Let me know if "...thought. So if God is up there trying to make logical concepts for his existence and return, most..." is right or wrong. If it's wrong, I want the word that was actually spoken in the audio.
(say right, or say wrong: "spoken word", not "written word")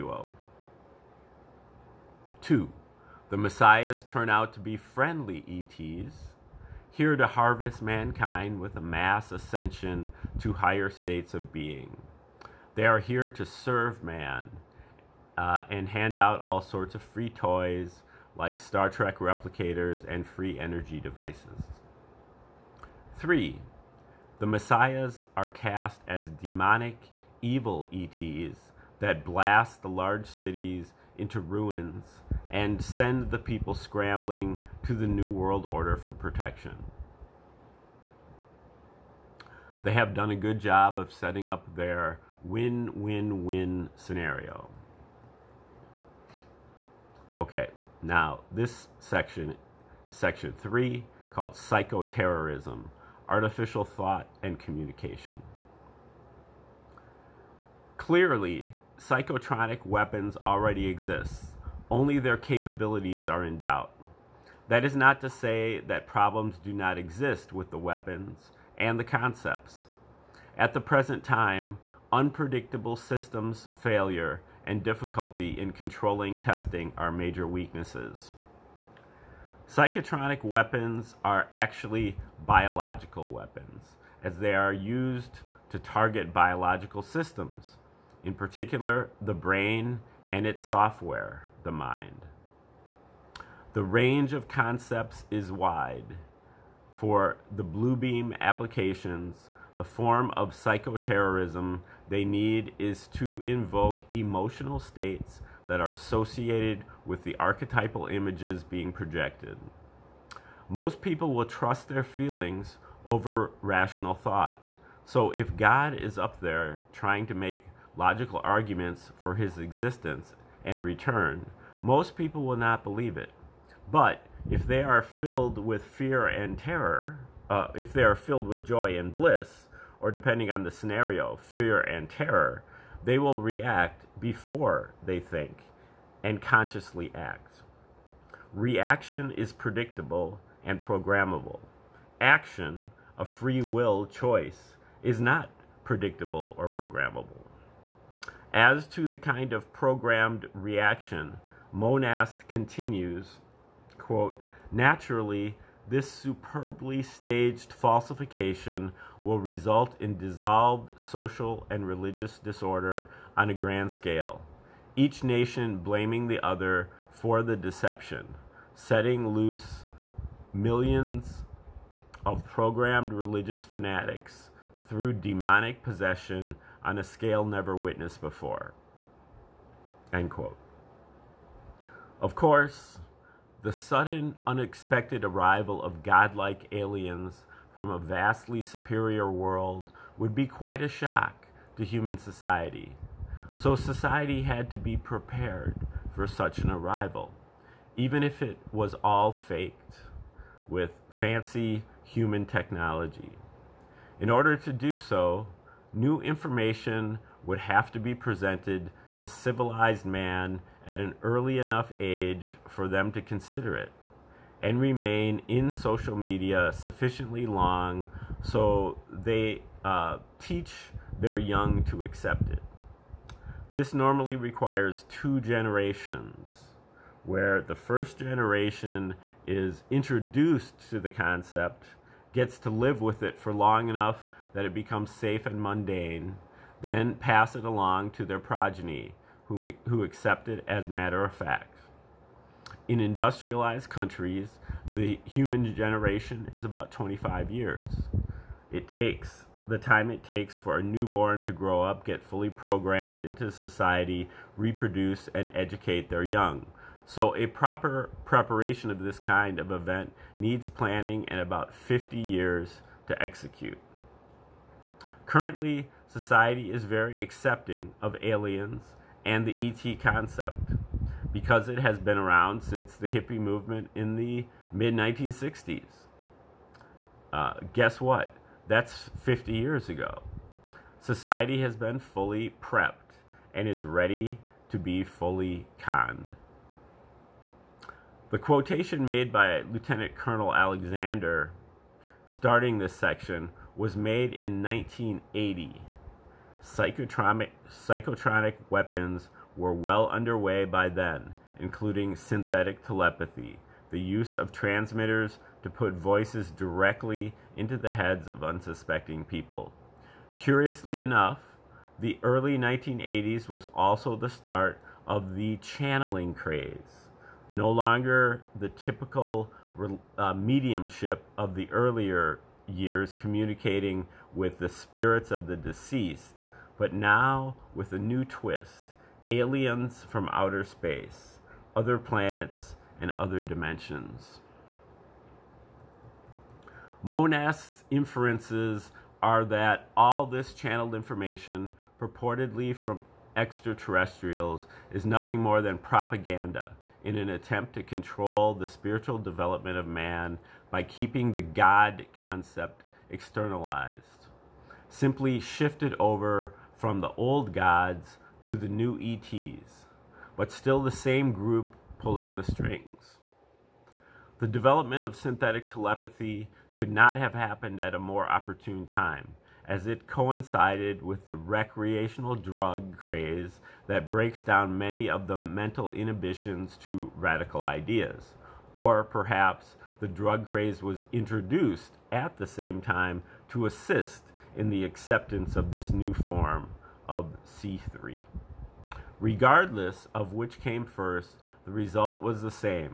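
wrong: "arguments", not "concepts".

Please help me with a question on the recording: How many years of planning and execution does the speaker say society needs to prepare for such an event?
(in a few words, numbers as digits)
50.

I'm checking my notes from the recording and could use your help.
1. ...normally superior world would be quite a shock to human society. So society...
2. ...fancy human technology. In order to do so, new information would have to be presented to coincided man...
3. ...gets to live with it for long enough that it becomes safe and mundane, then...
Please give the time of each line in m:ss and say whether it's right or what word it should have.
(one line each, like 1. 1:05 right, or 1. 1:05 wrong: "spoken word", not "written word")
1. 3:07 wrong: "vastly", not "normally"
2. 3:21 wrong: "civilized", not "coincided"
3. 3:52 right.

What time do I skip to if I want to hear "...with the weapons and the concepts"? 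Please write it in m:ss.
1:07.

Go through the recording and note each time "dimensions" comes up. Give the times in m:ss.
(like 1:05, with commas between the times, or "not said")
5:33.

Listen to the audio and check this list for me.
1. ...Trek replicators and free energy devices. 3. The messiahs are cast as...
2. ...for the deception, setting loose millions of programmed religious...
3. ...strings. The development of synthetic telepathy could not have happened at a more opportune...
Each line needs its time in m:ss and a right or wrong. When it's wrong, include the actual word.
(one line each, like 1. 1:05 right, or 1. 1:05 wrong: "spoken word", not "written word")
1. 0:18 right
2. 2:47 right
3. 6:02 right.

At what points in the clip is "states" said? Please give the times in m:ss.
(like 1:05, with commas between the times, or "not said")
0:10, 1:44.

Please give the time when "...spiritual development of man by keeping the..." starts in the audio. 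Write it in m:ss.
5:48.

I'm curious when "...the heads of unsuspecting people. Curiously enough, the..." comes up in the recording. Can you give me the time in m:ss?
5:07.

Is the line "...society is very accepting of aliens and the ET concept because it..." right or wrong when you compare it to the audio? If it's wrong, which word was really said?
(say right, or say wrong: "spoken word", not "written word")
right.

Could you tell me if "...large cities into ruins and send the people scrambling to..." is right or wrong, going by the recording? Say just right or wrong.
right.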